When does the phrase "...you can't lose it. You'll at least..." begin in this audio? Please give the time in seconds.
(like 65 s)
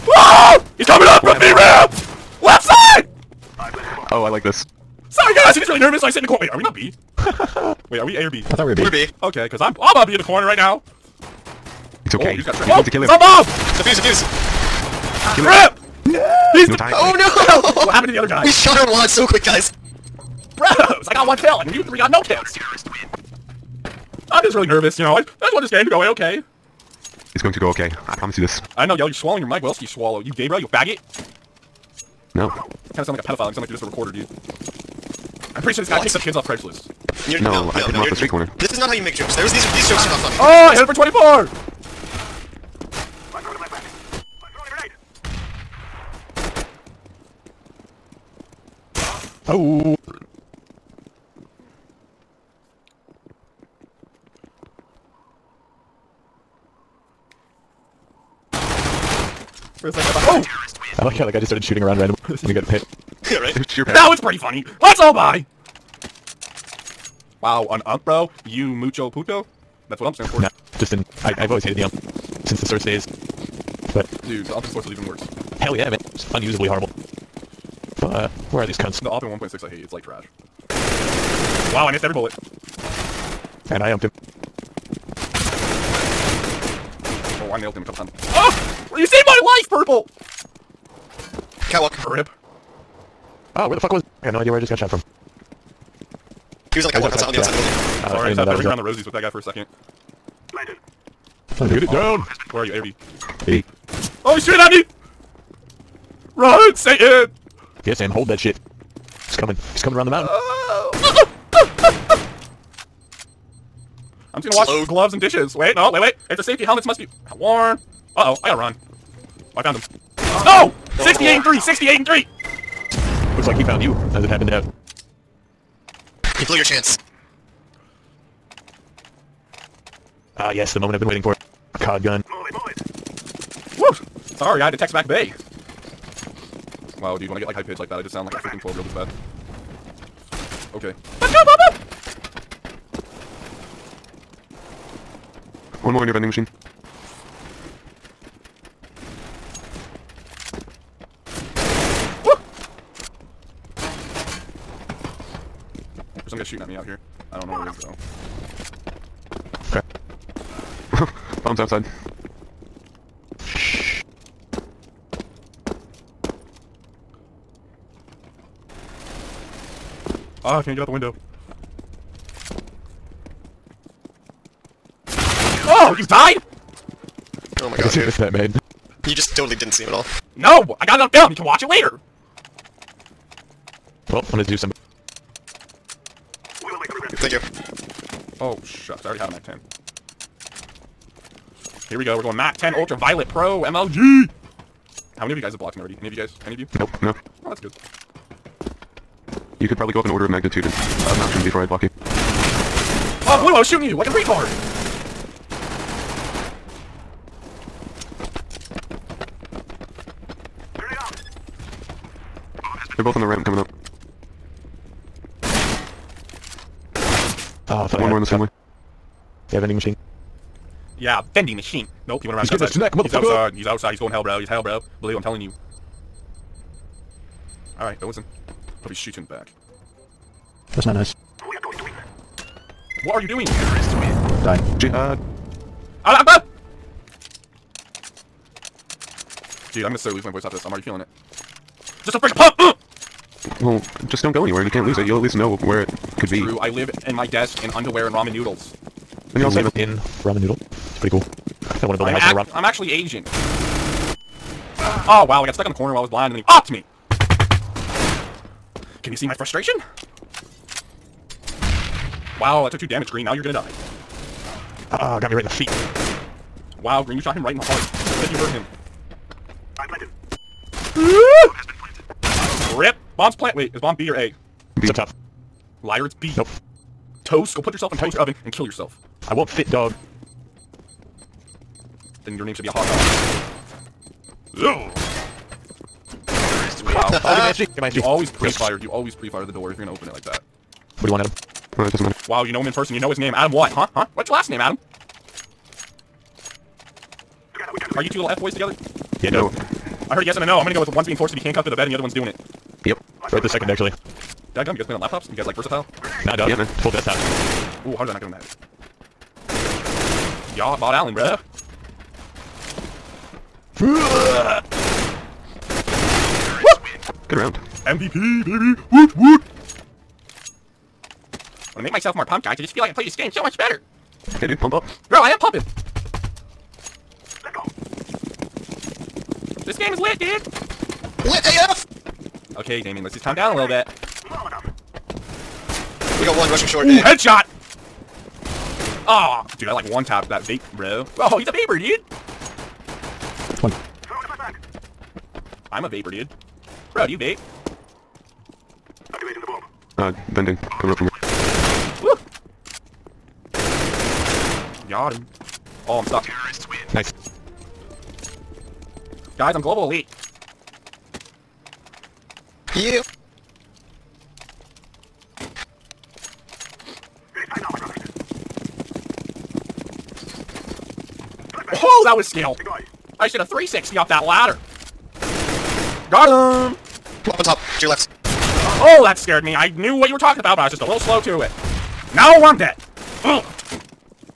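244 s.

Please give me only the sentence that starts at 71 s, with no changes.
I, I've always hated the ump.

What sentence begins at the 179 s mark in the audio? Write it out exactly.
You just totally didn't see him at all.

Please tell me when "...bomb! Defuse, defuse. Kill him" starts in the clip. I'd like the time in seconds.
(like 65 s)
13 s.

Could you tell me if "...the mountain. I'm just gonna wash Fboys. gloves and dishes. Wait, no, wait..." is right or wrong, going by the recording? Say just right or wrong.
wrong.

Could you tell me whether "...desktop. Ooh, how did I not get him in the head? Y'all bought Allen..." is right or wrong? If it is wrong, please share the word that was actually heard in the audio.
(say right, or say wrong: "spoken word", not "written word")
right.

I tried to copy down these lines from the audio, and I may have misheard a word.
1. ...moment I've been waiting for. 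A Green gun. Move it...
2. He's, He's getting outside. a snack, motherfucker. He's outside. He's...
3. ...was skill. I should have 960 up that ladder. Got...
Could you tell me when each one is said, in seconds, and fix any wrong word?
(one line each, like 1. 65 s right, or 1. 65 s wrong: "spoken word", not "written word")
1. 130 s wrong: "COD", not "Green"
2. 222 s right
3. 372 s wrong: "360", not "960".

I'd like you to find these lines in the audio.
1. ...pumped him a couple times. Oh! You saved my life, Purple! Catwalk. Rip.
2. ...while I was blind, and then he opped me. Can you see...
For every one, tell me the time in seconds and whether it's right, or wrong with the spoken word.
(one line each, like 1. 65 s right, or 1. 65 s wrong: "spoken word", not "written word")
1. 87 s wrong: "nailed", not "pumped"
2. 255 s right.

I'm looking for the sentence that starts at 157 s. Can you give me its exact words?
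I don't know where he is though.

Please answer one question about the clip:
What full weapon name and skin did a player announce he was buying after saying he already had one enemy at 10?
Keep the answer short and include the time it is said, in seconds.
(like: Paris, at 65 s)
MAC 10 Ultraviolet, at 192 s.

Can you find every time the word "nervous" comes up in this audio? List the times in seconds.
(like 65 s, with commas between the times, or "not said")
5 s, 24 s.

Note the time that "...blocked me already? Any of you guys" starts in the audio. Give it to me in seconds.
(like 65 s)
195 s.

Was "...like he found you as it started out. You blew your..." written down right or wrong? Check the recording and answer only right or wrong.
wrong.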